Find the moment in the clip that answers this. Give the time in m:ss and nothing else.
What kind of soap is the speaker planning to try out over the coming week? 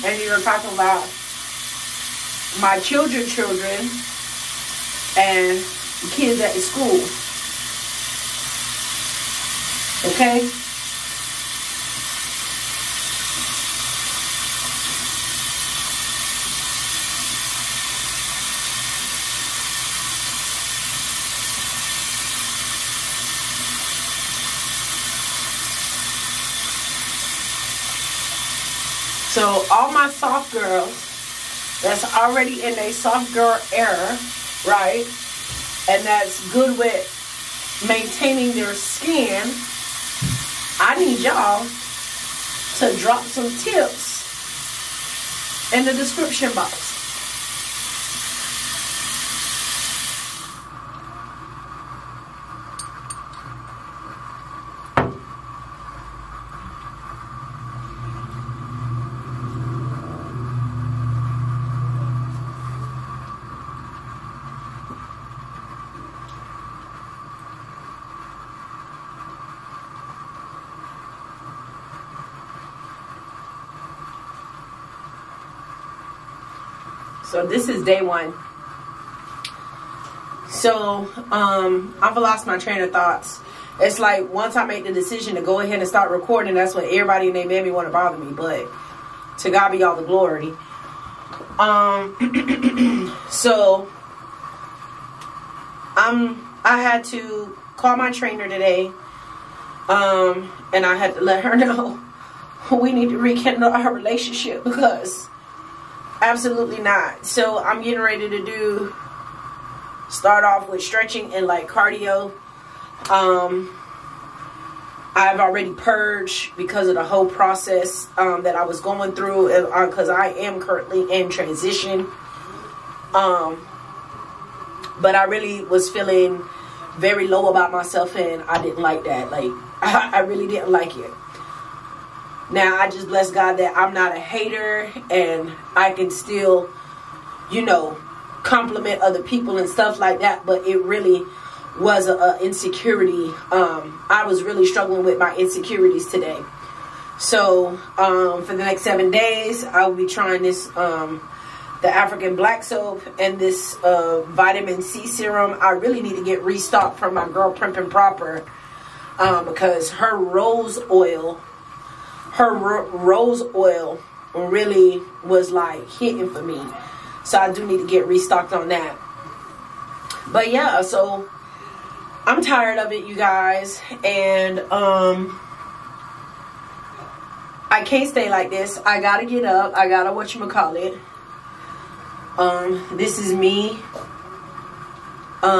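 2:31.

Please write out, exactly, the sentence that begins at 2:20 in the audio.
But it really was a, a insecurity.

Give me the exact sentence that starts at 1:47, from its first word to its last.
So I'm getting ready to do start off with stretching and like cardio.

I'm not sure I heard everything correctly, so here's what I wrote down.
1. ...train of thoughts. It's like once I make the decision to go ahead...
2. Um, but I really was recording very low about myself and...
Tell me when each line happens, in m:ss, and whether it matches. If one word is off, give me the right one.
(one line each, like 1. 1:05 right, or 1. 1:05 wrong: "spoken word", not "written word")
1. 1:22 right
2. 2:03 wrong: "feeling", not "recording".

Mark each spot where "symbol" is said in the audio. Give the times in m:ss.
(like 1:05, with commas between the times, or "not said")
not said.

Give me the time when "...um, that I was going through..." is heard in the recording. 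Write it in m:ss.
1:58.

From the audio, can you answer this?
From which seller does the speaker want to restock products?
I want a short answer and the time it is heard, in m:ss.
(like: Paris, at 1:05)
Primp and Proper, at 2:37.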